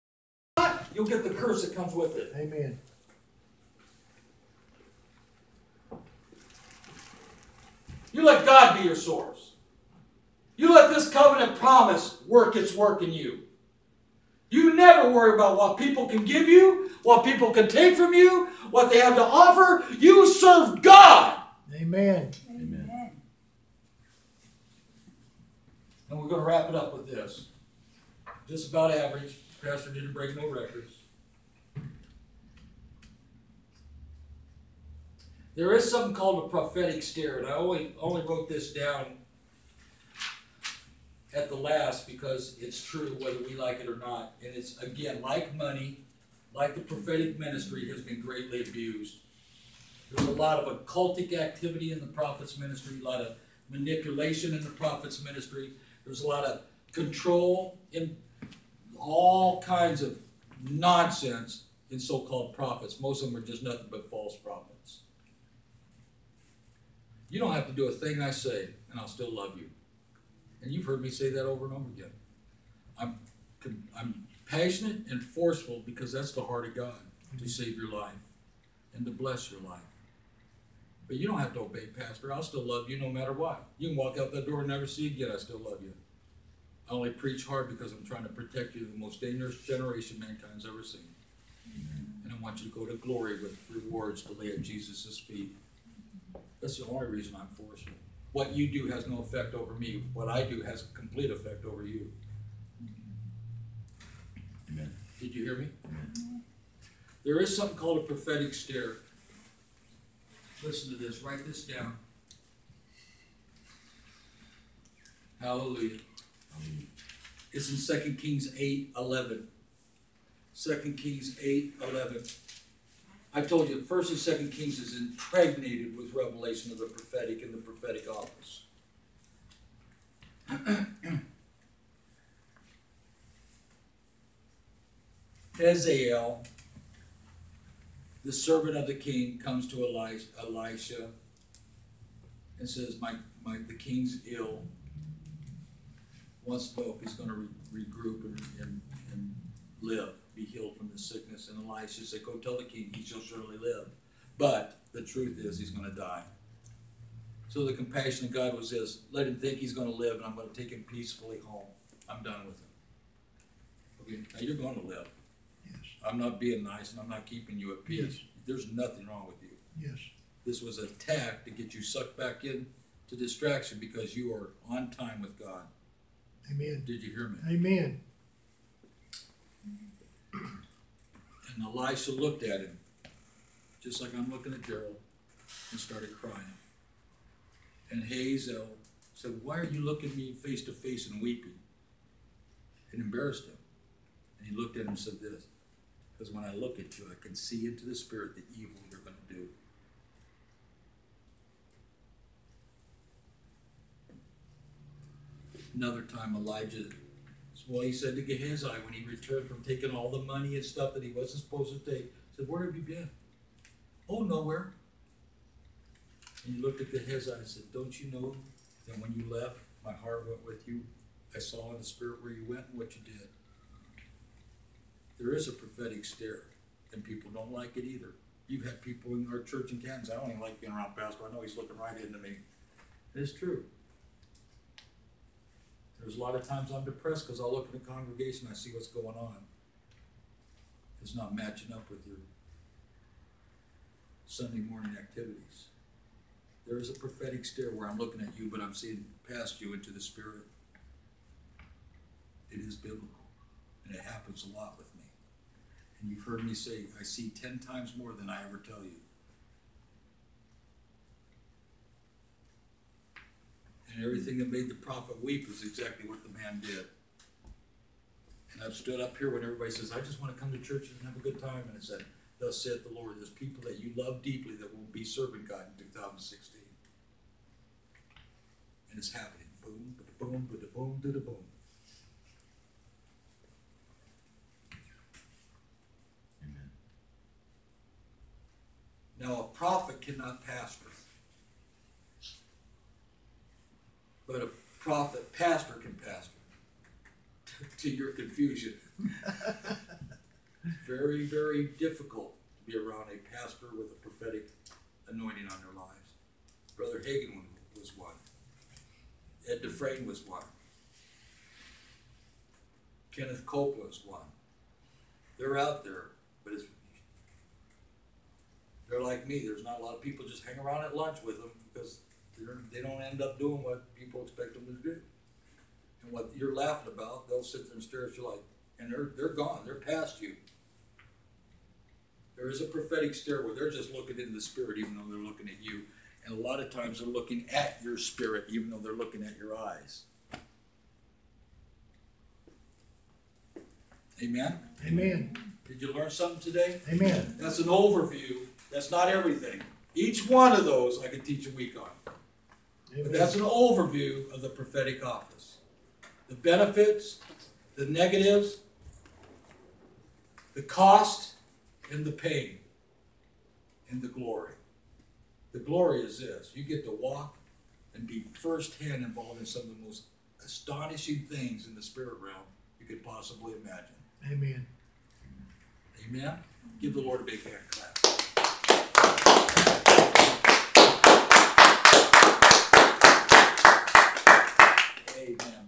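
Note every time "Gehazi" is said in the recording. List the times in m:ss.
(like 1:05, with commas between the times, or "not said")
3:28, 3:36.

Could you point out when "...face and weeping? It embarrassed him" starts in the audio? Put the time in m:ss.
3:10.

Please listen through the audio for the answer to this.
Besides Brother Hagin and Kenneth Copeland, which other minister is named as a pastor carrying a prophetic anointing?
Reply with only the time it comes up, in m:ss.
5:09.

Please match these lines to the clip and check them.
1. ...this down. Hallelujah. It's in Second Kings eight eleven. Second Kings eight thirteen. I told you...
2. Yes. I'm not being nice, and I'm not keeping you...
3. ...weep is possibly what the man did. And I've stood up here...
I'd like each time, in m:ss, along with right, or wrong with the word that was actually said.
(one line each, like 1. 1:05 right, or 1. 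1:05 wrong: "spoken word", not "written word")
1. 1:51 wrong: "eleven", not "thirteen"
2. 2:45 right
3. 4:25 wrong: "exactly", not "possibly".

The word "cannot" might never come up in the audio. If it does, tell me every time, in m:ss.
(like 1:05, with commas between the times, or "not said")
4:50.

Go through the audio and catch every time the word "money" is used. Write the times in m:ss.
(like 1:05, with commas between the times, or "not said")
0:45, 3:30.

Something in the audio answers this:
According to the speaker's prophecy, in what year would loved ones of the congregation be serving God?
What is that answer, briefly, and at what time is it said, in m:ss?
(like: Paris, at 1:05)
2016, at 4:35.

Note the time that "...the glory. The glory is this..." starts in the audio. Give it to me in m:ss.
6:04.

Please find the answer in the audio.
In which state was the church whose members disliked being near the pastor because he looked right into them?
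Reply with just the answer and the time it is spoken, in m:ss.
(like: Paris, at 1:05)
Kansas, at 3:49.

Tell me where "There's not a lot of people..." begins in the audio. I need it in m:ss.
5:19.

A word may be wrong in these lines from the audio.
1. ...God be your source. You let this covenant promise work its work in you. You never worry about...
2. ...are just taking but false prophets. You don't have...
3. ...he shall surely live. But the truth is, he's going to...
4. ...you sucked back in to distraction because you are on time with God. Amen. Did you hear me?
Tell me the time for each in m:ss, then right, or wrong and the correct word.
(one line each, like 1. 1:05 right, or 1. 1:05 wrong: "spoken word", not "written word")
1. 0:08 right
2. 1:03 wrong: "nothing", not "taking"
3. 2:32 right
4. 2:51 right.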